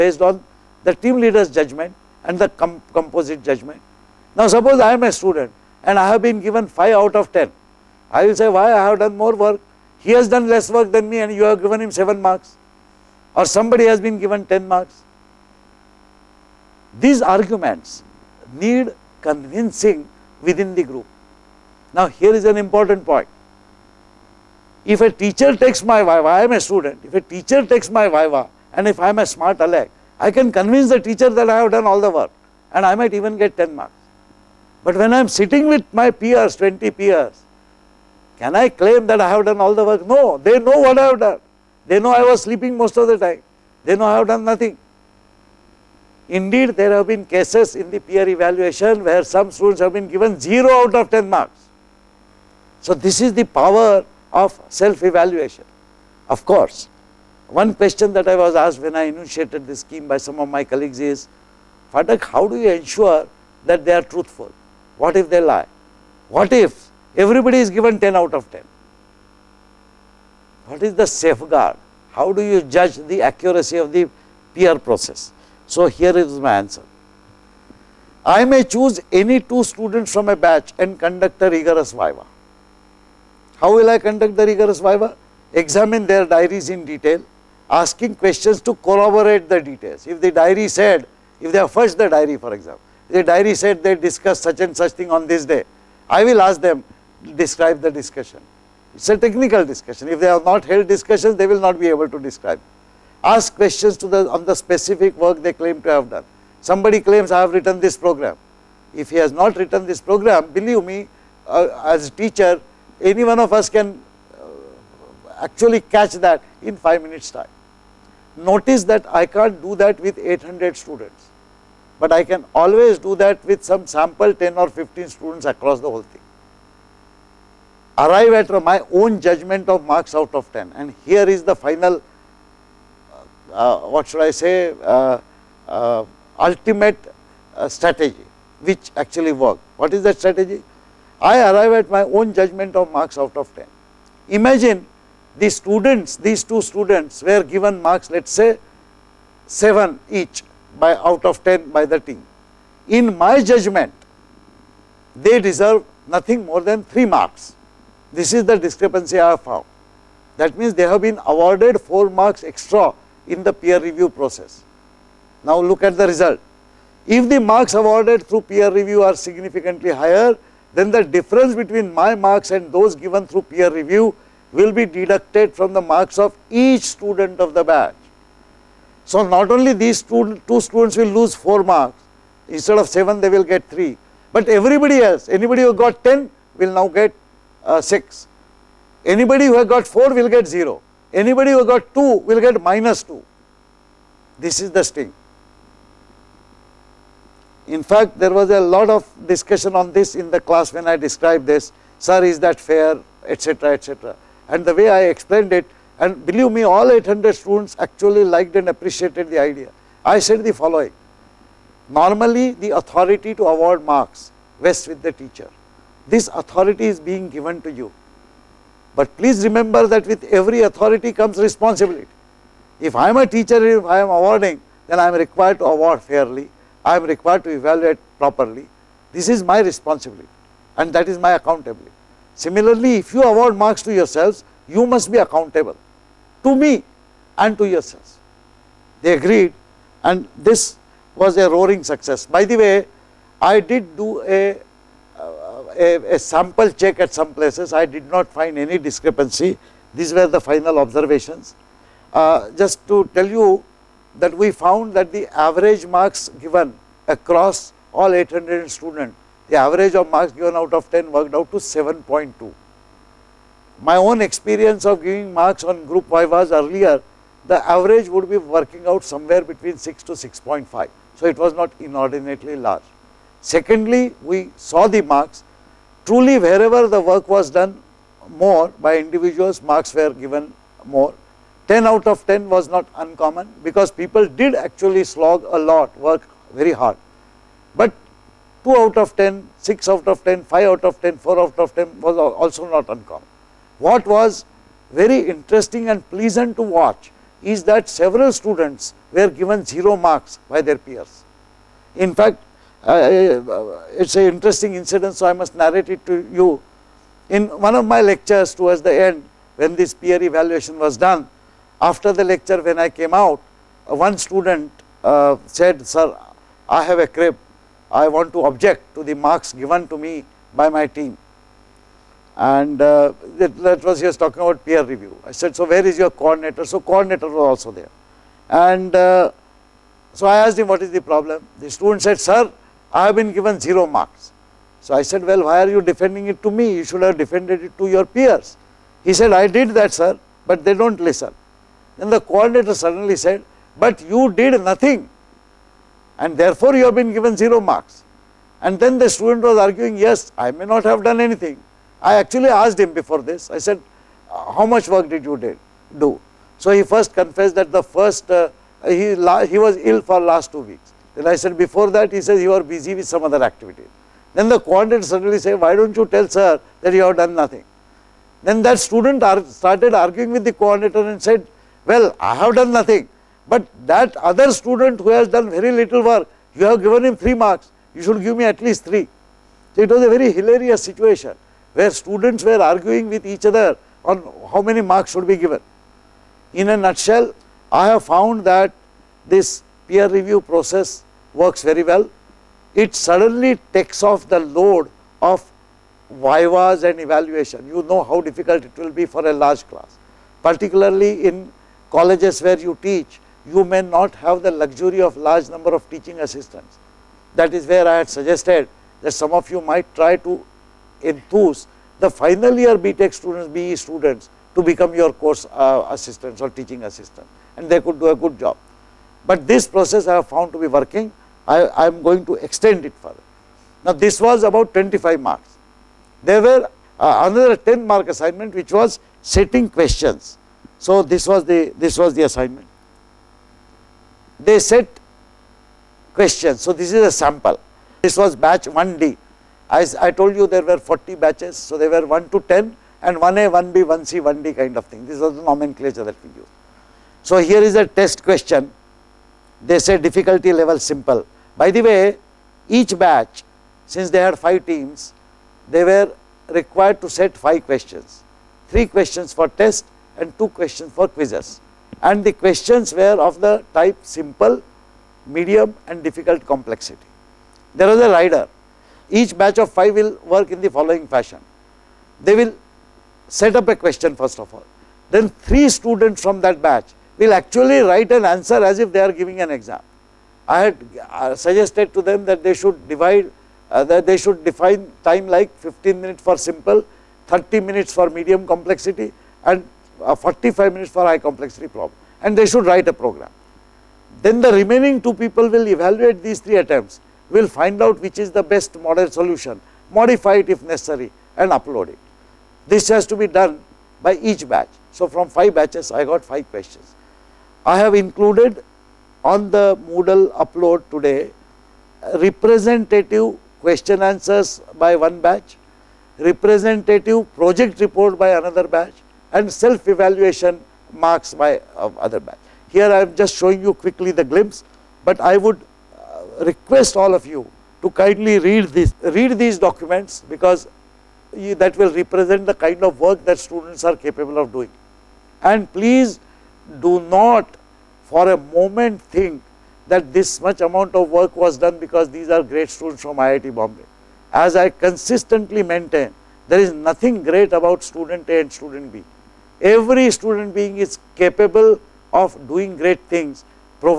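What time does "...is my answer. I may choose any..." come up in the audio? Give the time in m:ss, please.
1:16.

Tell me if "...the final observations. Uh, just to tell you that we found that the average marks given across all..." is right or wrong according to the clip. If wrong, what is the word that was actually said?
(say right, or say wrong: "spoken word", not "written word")
right.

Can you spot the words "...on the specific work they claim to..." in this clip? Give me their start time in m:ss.
1:44.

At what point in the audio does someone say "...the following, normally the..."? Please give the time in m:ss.
3:30.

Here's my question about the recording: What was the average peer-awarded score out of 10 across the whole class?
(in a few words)
7.2.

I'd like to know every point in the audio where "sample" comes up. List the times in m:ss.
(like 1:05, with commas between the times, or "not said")
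2:03, 4:06, 7:17.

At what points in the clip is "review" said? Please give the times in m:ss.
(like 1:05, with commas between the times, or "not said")
2:43, 2:48, 2:53, 5:24, 6:30.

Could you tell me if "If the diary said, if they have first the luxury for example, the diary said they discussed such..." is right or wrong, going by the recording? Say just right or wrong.
wrong.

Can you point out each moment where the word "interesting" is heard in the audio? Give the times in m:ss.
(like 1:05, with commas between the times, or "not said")
4:55, 5:04.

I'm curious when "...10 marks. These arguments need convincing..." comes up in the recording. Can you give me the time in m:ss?
0:14.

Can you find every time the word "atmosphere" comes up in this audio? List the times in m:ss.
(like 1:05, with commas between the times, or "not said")
not said.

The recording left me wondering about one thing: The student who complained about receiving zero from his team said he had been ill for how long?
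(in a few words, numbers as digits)
2 weeks.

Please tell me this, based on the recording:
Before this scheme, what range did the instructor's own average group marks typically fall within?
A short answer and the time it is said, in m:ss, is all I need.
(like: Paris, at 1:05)
6 to 6.5, at 4:29.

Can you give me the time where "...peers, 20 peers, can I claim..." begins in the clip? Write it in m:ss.
0:36.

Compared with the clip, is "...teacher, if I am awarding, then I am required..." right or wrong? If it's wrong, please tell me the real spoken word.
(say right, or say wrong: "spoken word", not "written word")
right.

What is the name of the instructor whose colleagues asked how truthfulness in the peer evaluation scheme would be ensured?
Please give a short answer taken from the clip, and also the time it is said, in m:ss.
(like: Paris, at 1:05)
Phatak, at 1:01.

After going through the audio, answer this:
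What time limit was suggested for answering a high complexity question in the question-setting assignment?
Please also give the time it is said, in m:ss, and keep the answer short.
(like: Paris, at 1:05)
45 minutes, at 8:10.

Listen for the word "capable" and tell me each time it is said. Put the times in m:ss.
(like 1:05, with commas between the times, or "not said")
8:53, 9:11.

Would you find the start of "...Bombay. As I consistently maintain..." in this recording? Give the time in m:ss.
9:03.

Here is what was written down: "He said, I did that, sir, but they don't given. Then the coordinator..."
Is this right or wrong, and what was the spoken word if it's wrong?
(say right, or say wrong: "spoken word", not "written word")
wrong: "listen", not "given".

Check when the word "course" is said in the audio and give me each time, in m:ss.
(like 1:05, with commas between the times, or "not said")
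0:56, 6:55.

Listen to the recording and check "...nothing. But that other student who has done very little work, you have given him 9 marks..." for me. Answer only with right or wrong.
wrong.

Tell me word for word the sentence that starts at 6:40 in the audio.
Particularly in colleges where you teach, you may not have the luxury of large number of teaching assistants.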